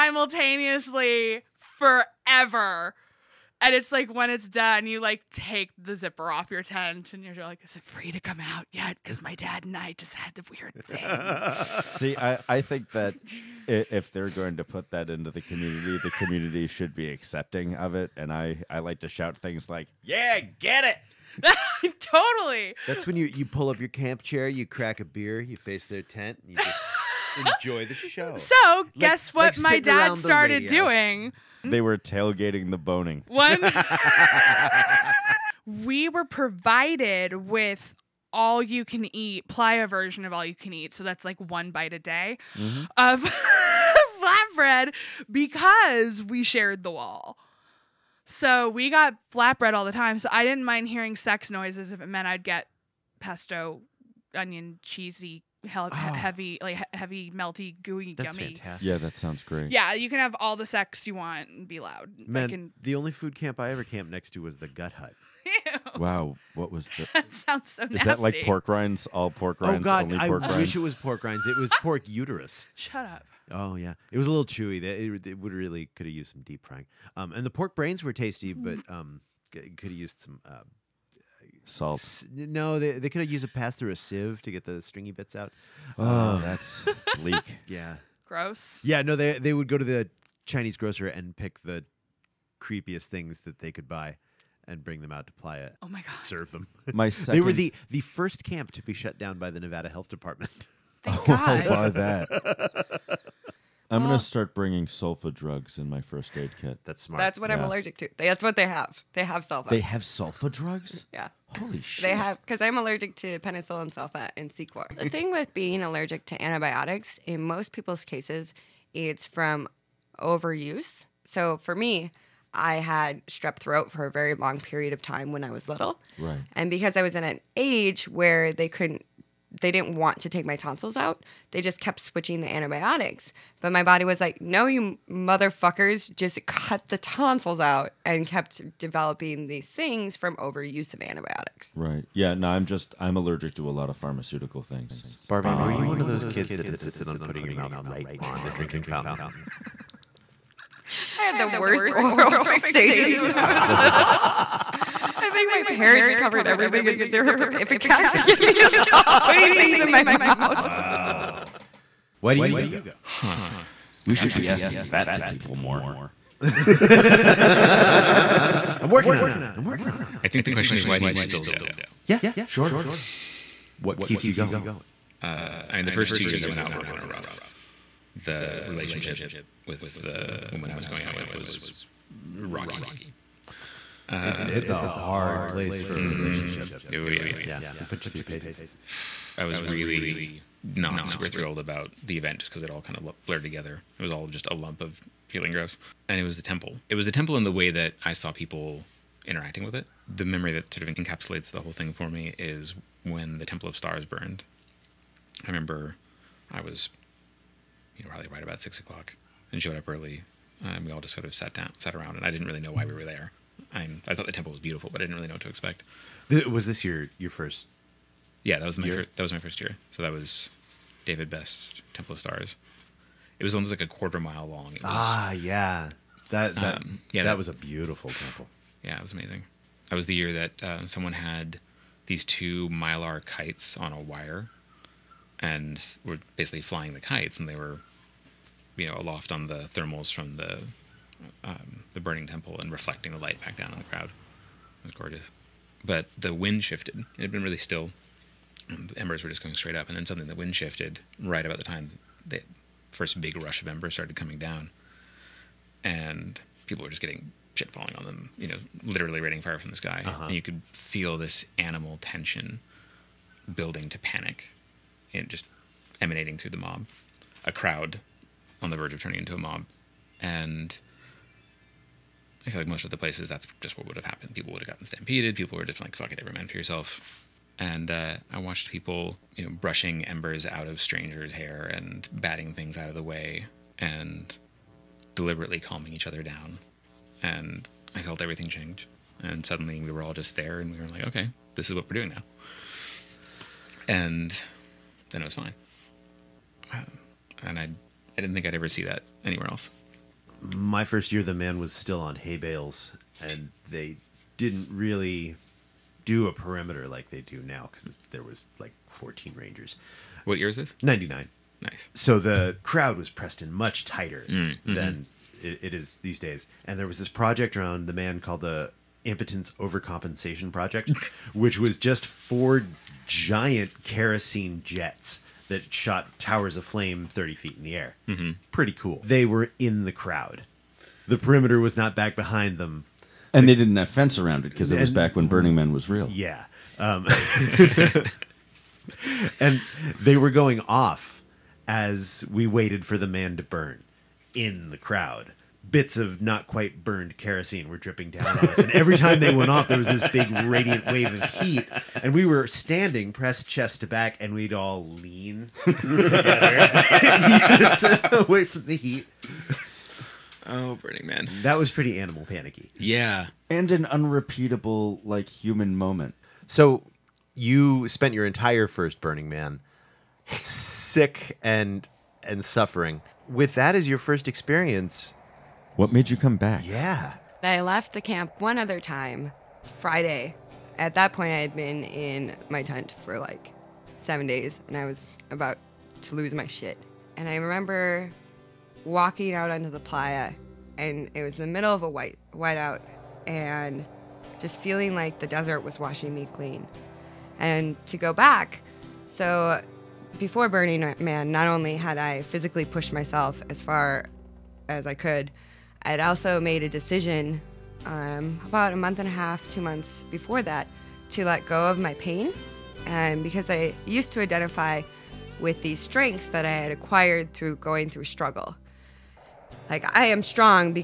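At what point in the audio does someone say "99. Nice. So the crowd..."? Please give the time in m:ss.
5:10.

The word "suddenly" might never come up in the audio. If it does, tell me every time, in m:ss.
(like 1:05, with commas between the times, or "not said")
4:10, 4:49.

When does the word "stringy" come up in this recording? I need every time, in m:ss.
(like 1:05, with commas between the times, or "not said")
1:24.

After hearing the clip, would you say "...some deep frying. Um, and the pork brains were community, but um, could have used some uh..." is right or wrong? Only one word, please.
wrong.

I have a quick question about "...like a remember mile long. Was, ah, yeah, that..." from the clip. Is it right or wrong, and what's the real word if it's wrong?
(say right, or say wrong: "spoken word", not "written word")
wrong: "quarter", not "remember".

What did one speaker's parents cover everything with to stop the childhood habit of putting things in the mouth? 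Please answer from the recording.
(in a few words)
Syrup of Ipecac.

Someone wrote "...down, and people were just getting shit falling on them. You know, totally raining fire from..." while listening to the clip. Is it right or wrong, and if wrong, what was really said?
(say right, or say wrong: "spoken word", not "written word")
wrong: "literally", not "totally".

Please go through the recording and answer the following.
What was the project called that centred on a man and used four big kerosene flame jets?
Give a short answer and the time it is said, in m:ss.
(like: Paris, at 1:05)
Impotence Overcompensation Project, at 5:19.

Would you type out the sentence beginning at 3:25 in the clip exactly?
I remember I was, you know, probably right about six o'clock and showed up early.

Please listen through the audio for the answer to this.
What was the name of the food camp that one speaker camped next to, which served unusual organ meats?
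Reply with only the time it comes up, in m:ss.
1:04.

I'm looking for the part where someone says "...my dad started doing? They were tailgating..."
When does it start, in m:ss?
0:29.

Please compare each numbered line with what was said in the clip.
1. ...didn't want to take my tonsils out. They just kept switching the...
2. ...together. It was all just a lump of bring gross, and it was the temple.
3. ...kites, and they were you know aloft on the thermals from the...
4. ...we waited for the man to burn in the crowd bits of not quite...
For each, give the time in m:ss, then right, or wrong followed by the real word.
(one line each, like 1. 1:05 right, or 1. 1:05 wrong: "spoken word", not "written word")
1. 2:09 right
2. 3:13 wrong: "feeling", not "bring"
3. 3:56 right
4. 5:42 right.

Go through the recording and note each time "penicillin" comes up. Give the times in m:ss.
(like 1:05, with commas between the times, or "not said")
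1:53.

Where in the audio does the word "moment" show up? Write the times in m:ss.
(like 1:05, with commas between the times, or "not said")
6:05.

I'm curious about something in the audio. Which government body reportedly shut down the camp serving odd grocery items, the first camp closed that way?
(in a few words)
Nevada Health Department.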